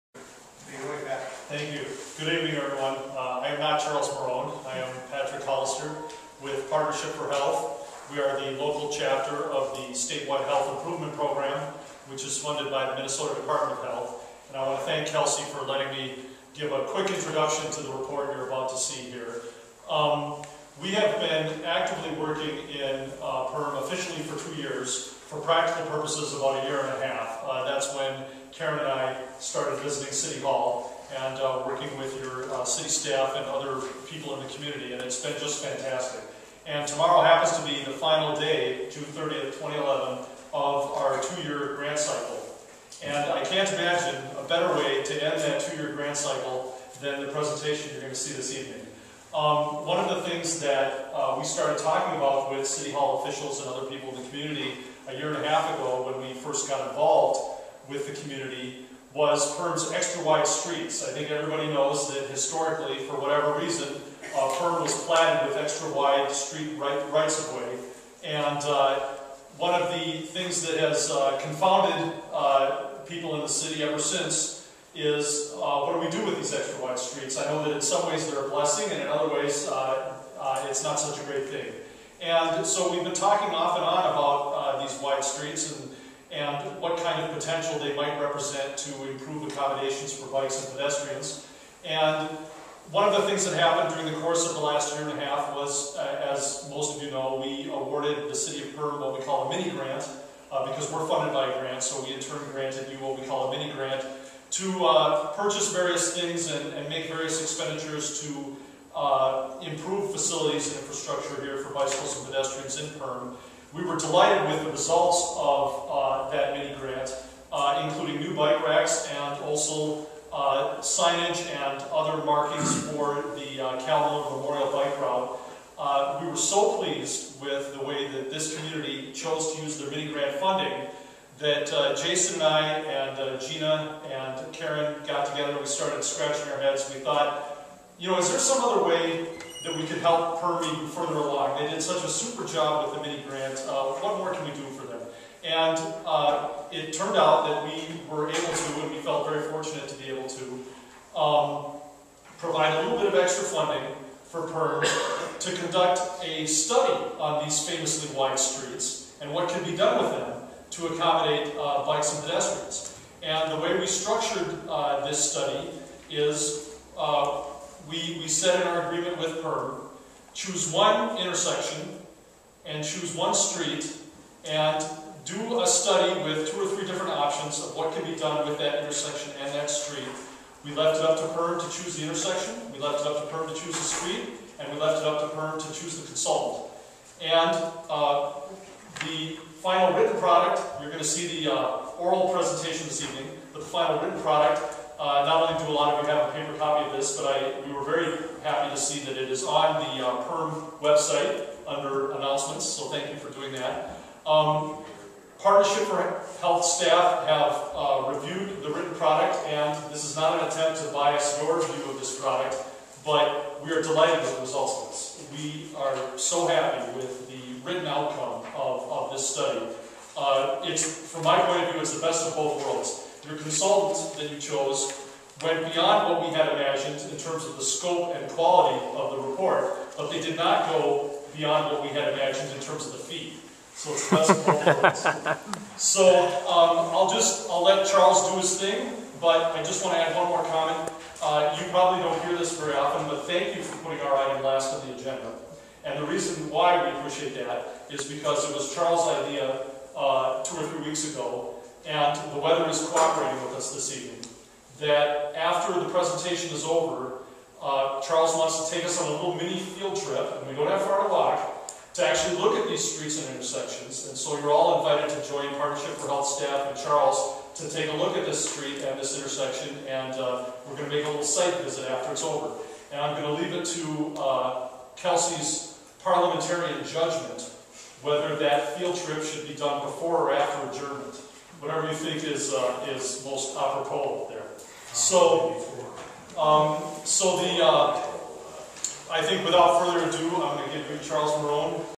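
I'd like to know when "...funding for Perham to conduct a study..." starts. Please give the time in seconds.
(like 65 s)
153 s.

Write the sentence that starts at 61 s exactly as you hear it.
I think everybody knows that historically, for whatever reason, uh, Perham was platted with extra wide street right, rights of way.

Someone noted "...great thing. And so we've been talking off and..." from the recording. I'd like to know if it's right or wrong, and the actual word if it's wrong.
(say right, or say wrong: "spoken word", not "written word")
right.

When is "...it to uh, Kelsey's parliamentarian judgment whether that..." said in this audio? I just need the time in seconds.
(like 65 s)
273 s.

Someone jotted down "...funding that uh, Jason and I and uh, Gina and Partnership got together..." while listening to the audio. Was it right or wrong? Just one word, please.
wrong.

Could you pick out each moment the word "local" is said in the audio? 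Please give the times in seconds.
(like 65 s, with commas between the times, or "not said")
8 s.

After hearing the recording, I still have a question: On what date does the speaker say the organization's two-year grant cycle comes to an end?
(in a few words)
June 30th, 2011.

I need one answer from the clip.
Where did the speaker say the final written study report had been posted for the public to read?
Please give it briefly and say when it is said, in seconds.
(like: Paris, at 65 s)
Perham website, at 200 s.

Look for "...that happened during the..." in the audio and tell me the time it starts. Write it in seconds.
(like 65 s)
93 s.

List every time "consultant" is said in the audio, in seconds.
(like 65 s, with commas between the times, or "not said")
186 s, 223 s.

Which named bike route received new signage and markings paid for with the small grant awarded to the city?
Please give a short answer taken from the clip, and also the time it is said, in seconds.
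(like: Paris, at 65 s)
Calhoun Memorial Bike Route, at 123 s.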